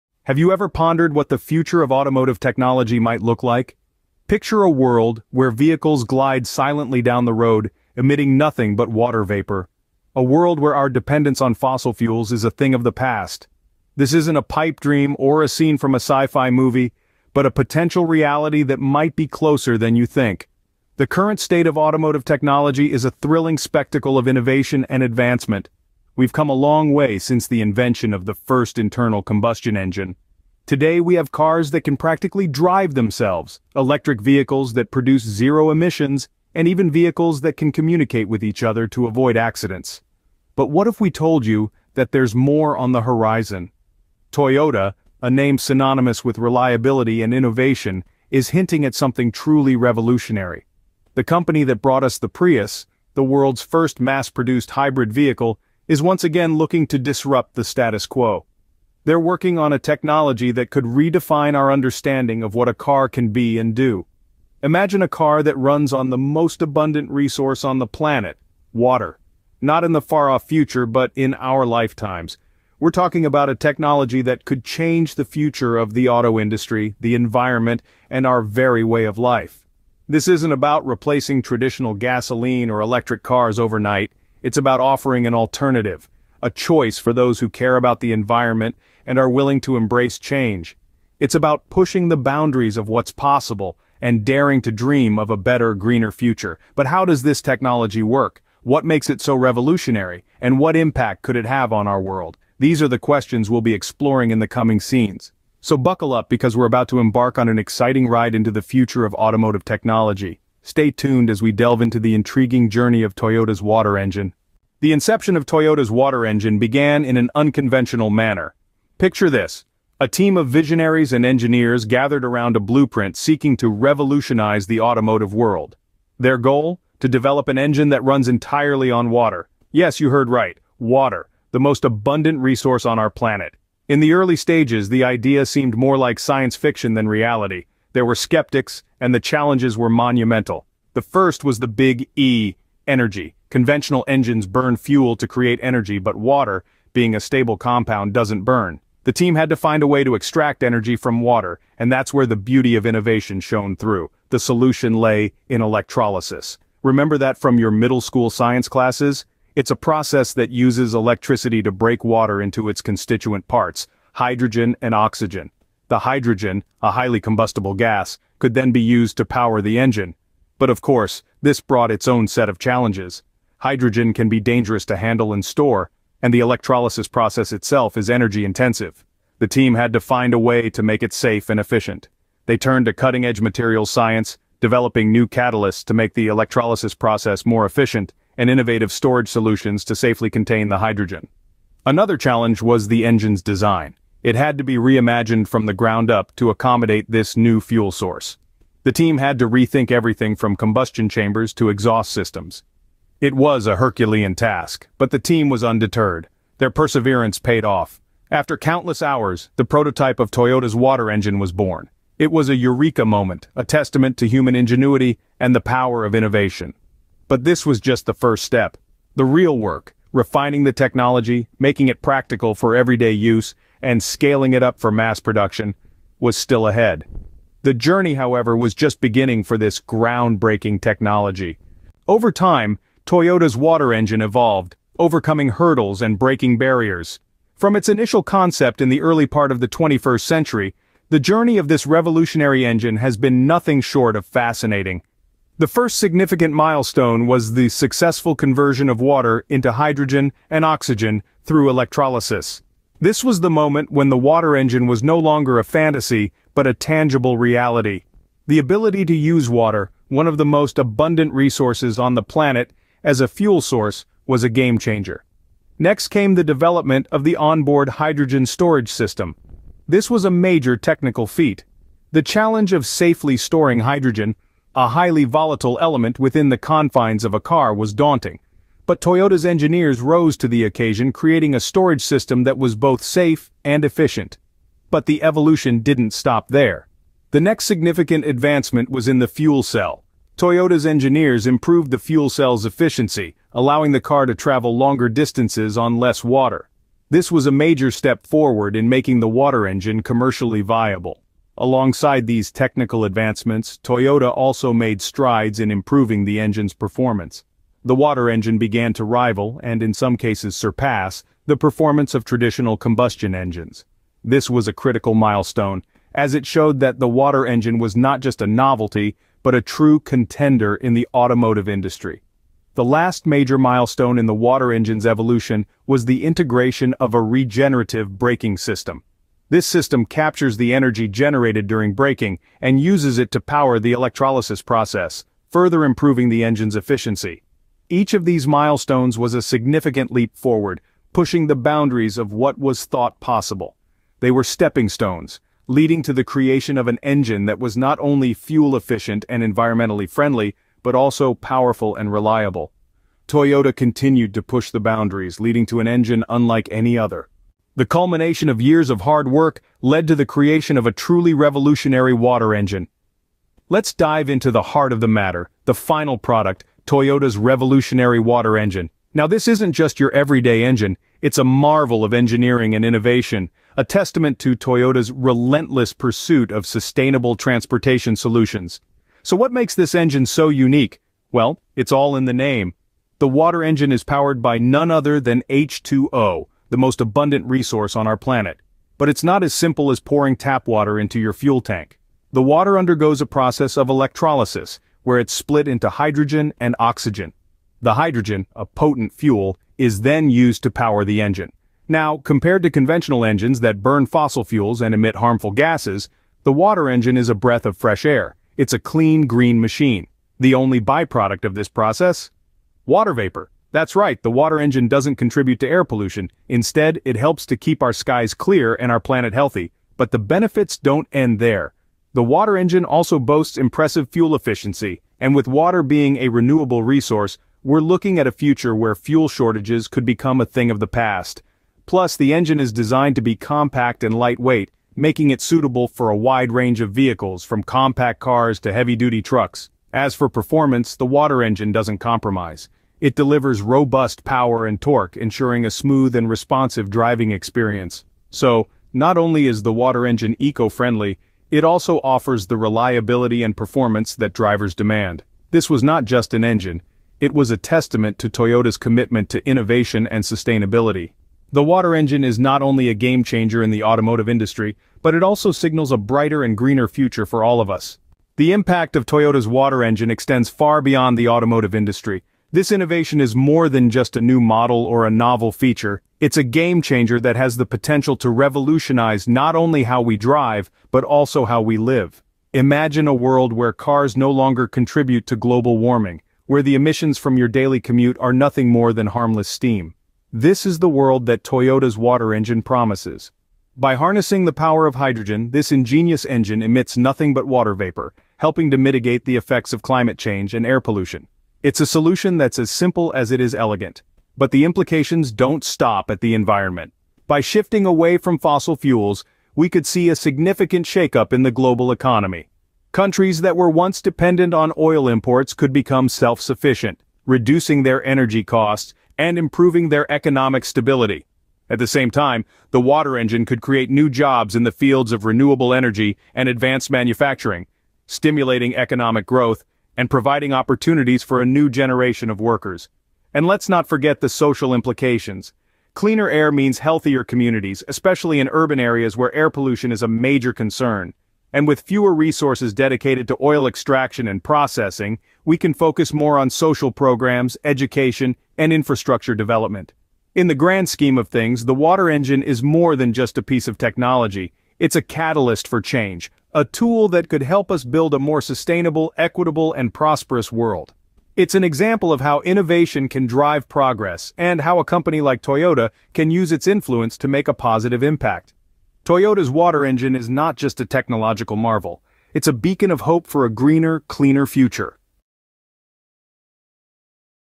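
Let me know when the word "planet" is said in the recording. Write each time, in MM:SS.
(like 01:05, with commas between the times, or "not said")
01:07, 02:13, 04:22, 06:28, 06:58.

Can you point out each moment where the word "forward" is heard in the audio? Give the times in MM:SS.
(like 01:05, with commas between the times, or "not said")
04:58, 05:40.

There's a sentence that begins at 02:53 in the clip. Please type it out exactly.
Hydrogen can be dangerous to handle and store, and the electrolysis process itself is energy-intensive.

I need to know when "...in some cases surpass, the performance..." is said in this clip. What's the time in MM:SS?
05:09.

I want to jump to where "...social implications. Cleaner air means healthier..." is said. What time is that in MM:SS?
08:54.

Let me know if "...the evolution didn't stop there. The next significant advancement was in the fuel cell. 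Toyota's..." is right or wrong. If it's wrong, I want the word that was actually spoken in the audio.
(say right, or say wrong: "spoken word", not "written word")
right.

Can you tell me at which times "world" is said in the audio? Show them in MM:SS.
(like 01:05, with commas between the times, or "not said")
00:04, 00:10, 00:53, 01:42, 02:05, 08:03, 08:10, 09:20.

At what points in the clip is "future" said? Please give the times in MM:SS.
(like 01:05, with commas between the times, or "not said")
00:01, 01:10, 01:15, 01:36, 01:48, 07:08, 07:46, 09:34.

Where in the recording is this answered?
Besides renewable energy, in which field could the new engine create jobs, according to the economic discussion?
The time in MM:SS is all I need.
08:46.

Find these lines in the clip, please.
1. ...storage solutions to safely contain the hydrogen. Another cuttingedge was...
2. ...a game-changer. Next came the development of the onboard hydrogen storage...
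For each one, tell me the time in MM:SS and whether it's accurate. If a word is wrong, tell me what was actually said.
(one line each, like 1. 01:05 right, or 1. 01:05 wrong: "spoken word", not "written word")
1. 03:08 wrong: "challenge", not "cuttingedge"
2. 04:24 right.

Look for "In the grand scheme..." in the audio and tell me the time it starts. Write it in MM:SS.
09:10.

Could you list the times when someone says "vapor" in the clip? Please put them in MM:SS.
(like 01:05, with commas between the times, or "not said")
00:09, 06:53, 08:17.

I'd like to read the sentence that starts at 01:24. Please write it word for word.
It's about offering an alternative, a choice for those who care about the environment and are willing to embrace change.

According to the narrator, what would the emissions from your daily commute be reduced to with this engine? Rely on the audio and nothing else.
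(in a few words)
harmless steam.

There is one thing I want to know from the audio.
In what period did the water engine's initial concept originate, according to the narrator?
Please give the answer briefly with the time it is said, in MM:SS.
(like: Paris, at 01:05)
early 21st century, at 03:59.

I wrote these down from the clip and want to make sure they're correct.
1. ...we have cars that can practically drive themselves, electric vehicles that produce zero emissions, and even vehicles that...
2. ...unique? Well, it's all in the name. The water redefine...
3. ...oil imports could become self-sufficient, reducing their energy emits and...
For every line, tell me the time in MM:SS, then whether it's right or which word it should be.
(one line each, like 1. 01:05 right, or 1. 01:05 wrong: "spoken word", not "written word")
1. 00:30 right
2. 06:20 wrong: "engine", not "redefine"
3. 08:34 wrong: "costs", not "emits".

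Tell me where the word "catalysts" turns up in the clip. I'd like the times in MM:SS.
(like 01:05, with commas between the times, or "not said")
03:05, 09:15.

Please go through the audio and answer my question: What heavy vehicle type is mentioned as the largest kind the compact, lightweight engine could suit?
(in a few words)
heavy-duty trucks.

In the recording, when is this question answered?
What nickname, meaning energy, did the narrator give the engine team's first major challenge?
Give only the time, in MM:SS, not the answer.
02:21.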